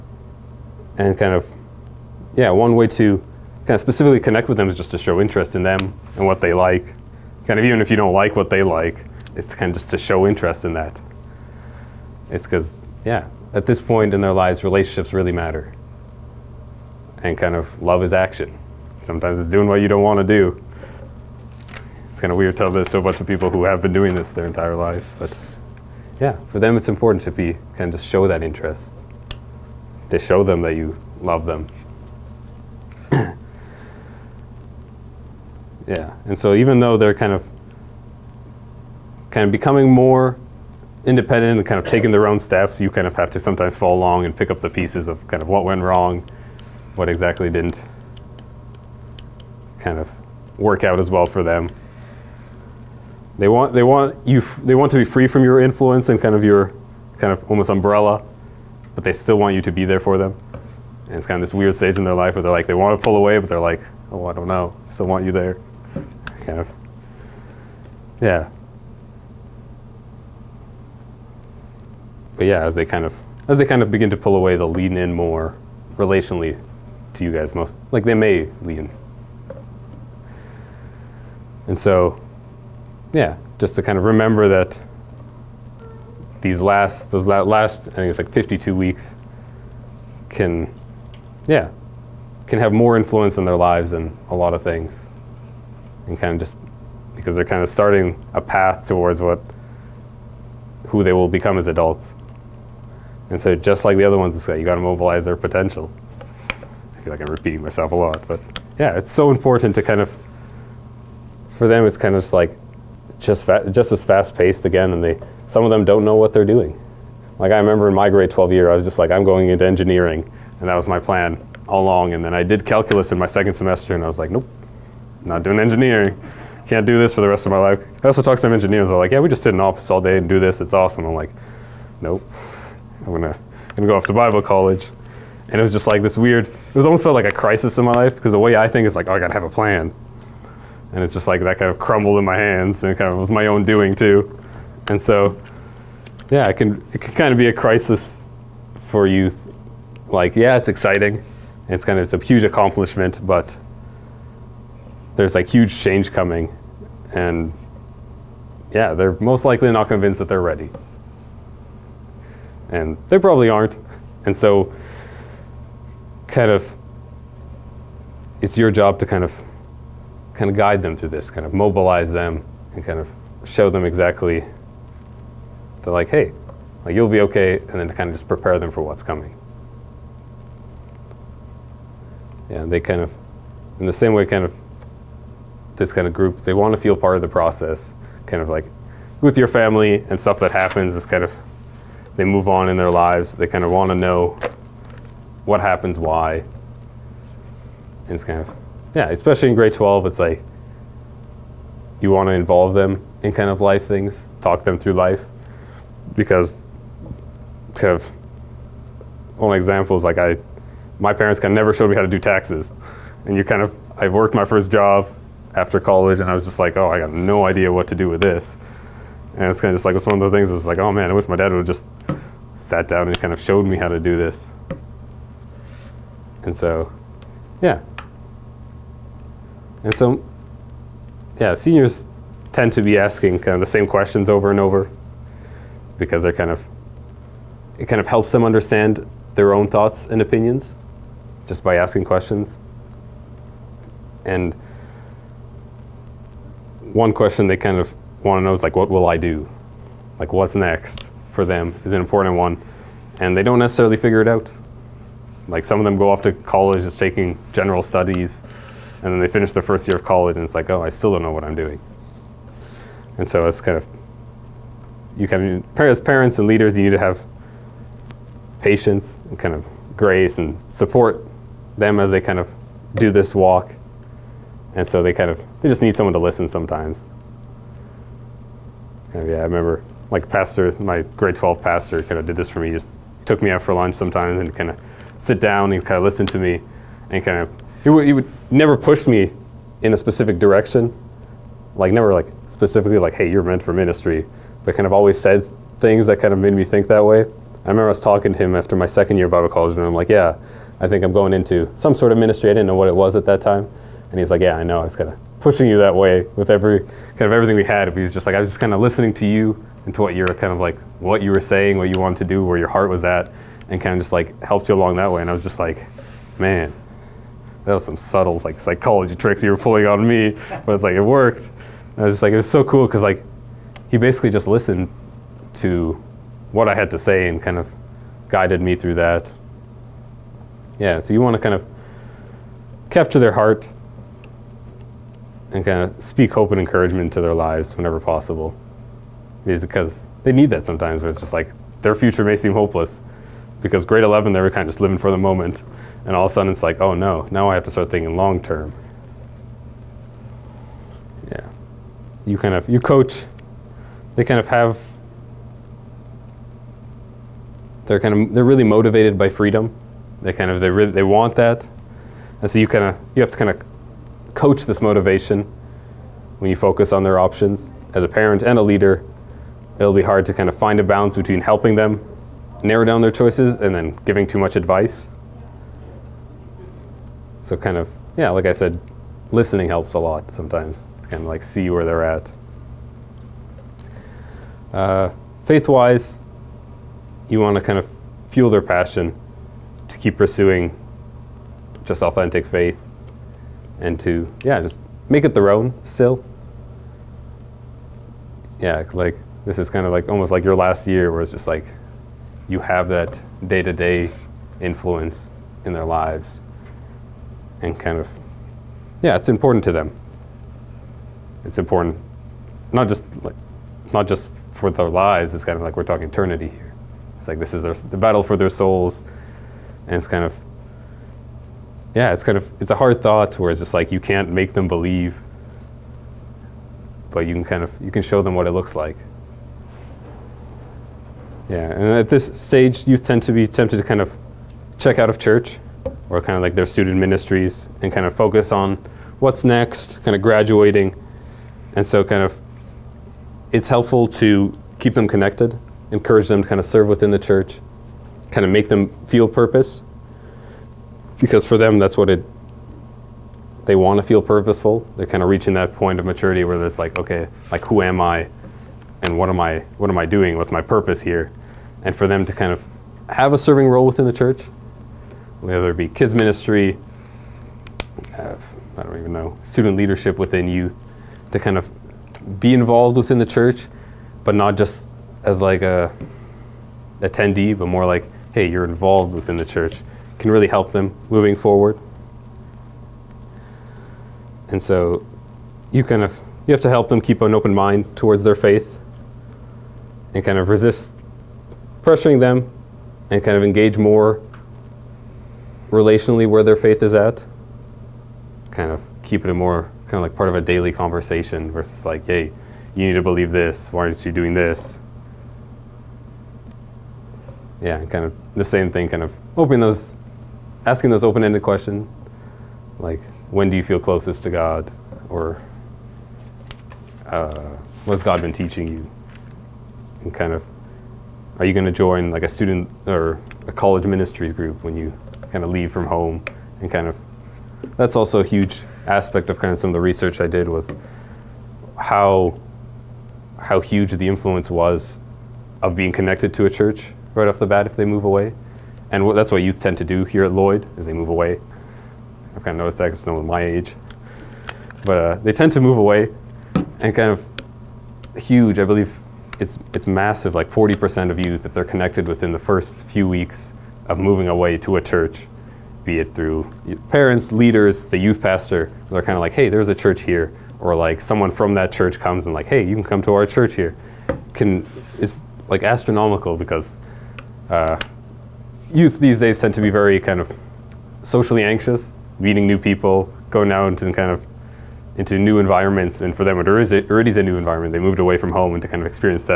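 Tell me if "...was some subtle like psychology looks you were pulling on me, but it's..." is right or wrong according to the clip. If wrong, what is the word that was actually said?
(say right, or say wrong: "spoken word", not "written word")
wrong: "tricks", not "looks".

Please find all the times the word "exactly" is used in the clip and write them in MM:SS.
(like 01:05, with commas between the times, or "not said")
00:47, 02:53.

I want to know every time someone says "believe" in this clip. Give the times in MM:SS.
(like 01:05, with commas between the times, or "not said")
07:04, 08:23, 09:08.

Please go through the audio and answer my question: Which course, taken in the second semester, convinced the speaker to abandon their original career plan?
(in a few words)
calculus.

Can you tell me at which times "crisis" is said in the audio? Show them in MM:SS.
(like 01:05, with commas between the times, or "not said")
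02:17, 02:27.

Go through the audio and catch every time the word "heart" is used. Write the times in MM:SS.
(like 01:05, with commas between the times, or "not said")
05:12, 05:33.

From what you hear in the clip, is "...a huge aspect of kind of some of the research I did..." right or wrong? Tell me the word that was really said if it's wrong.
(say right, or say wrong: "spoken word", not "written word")
right.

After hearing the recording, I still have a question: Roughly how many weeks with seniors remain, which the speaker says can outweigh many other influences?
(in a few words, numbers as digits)
52.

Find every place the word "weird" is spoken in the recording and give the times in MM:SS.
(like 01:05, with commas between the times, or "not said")
00:22, 01:01, 02:16.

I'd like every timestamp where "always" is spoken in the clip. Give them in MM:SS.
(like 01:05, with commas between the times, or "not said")
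04:54.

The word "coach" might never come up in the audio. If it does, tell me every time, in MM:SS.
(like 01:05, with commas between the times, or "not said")
05:52, 06:04.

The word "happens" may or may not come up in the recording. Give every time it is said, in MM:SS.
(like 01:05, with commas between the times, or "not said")
03:10, 03:15.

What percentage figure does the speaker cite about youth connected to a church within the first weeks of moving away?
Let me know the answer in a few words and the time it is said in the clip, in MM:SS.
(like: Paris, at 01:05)
40%, at 09:10.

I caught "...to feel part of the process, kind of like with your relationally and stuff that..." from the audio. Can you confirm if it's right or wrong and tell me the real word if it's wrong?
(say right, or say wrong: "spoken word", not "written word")
wrong: "family", not "relationally".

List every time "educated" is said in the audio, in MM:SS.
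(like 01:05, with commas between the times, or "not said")
not said.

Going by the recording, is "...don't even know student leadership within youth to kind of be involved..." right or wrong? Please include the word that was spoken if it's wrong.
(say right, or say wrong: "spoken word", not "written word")
right.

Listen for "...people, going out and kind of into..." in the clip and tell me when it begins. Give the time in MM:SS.
09:32.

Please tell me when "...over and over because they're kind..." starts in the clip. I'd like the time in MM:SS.
03:54.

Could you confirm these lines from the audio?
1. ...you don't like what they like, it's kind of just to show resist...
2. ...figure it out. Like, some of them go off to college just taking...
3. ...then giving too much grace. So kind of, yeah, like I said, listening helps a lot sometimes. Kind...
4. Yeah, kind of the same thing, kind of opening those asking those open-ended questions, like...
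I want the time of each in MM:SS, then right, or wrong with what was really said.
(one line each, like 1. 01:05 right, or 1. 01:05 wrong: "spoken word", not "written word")
1. 00:07 wrong: "interest", not "resist"
2. 04:13 right
3. 06:13 wrong: "advice", not "grace"
4. 08:27 right.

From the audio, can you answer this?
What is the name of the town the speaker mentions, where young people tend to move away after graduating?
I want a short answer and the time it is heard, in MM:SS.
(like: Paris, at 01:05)
Lloyd, at 09:00.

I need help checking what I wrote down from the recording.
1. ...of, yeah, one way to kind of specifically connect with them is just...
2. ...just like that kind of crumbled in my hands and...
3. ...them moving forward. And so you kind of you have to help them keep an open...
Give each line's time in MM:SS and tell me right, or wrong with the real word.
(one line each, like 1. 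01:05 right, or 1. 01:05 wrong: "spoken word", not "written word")
1. 00:01 right
2. 02:21 right
3. 08:00 right.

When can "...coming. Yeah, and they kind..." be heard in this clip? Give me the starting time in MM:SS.
02:59.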